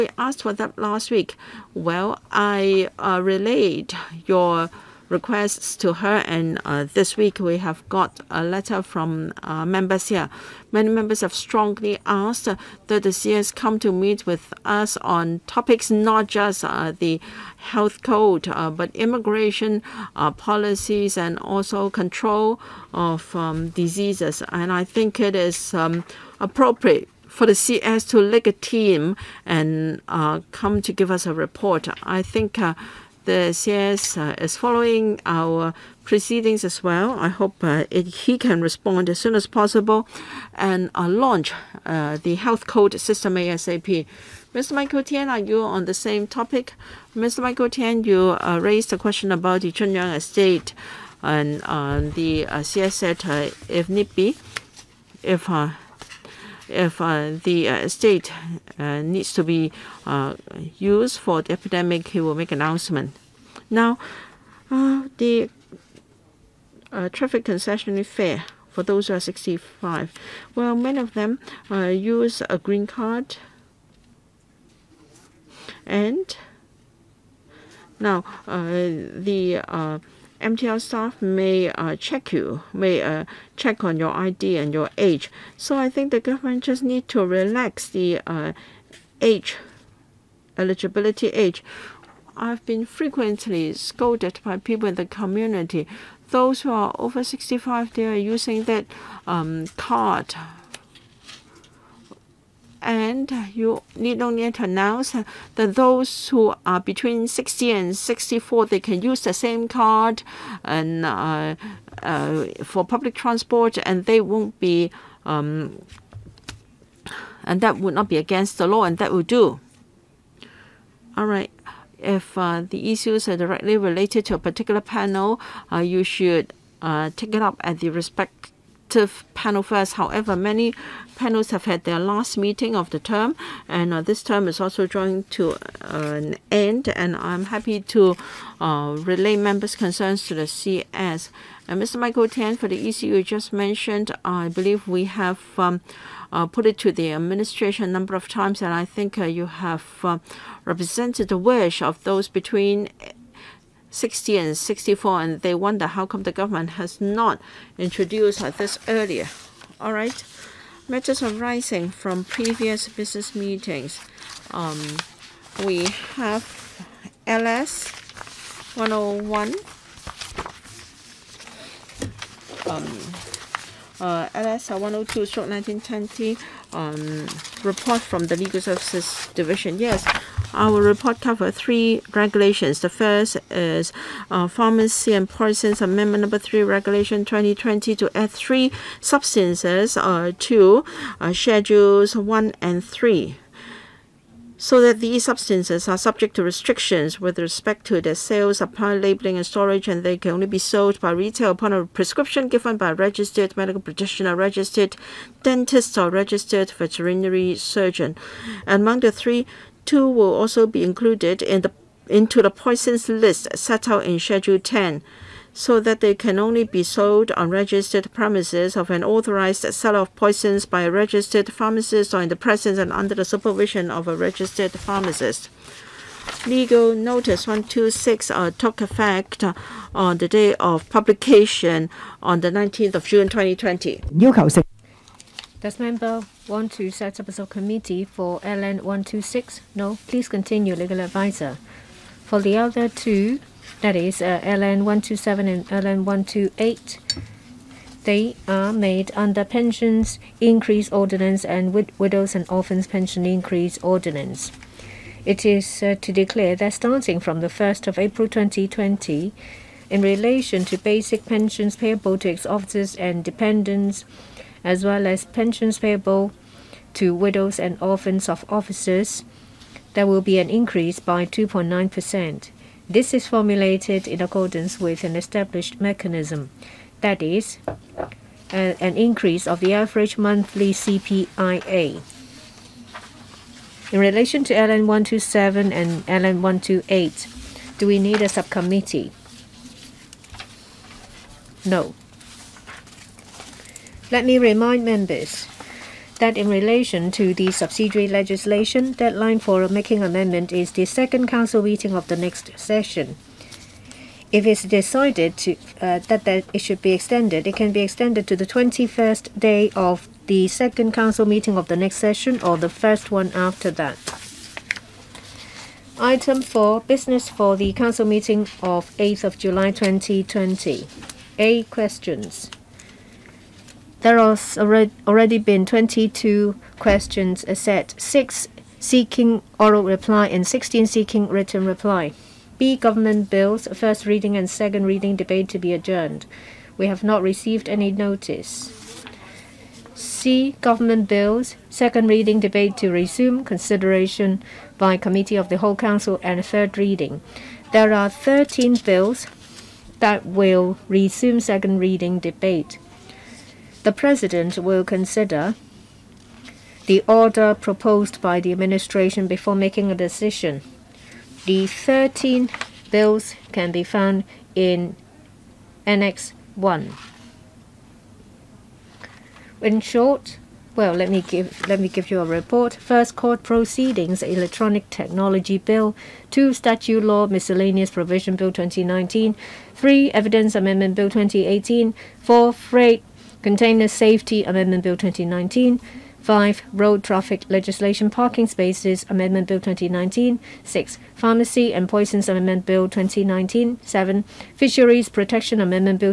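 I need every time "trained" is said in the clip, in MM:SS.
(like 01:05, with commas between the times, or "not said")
not said.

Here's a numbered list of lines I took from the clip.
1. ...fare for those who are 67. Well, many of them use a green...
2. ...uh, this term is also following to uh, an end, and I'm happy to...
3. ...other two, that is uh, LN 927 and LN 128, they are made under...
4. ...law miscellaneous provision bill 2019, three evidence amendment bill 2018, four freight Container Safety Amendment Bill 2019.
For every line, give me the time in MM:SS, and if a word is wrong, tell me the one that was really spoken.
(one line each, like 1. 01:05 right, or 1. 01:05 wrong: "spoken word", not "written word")
1. 01:08 wrong: "65", not "67"
2. 02:13 wrong: "drawing", not "following"
3. 04:02 wrong: "127", not "927"
4. 06:17 right.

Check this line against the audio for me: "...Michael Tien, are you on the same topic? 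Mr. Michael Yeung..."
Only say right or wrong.
wrong.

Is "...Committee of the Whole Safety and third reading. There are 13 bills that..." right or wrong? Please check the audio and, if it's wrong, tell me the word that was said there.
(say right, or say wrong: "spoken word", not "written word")
wrong: "Council", not "Safety".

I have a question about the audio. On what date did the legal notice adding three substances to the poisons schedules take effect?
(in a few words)
19 June 2020.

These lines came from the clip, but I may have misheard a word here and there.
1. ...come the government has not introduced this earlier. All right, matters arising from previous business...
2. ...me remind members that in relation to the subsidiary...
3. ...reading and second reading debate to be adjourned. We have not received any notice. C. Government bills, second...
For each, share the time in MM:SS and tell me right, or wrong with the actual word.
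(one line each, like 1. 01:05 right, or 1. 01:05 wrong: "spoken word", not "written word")
1. 02:36 right
2. 04:54 right
3. 05:34 right.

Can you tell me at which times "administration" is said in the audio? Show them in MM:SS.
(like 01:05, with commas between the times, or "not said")
02:27, 05:58.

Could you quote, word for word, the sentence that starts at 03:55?
Does member want to set up a subcommittee for LN 126?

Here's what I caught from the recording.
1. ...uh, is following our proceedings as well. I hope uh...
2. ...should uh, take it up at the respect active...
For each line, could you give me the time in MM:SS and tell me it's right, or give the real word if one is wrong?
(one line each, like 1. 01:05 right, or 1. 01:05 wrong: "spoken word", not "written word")
1. 00:34 right
2. 02:06 right.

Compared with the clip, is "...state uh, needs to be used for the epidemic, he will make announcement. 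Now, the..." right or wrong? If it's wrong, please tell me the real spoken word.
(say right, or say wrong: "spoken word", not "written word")
right.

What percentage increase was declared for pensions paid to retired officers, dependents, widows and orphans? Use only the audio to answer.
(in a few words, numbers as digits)
2.9%.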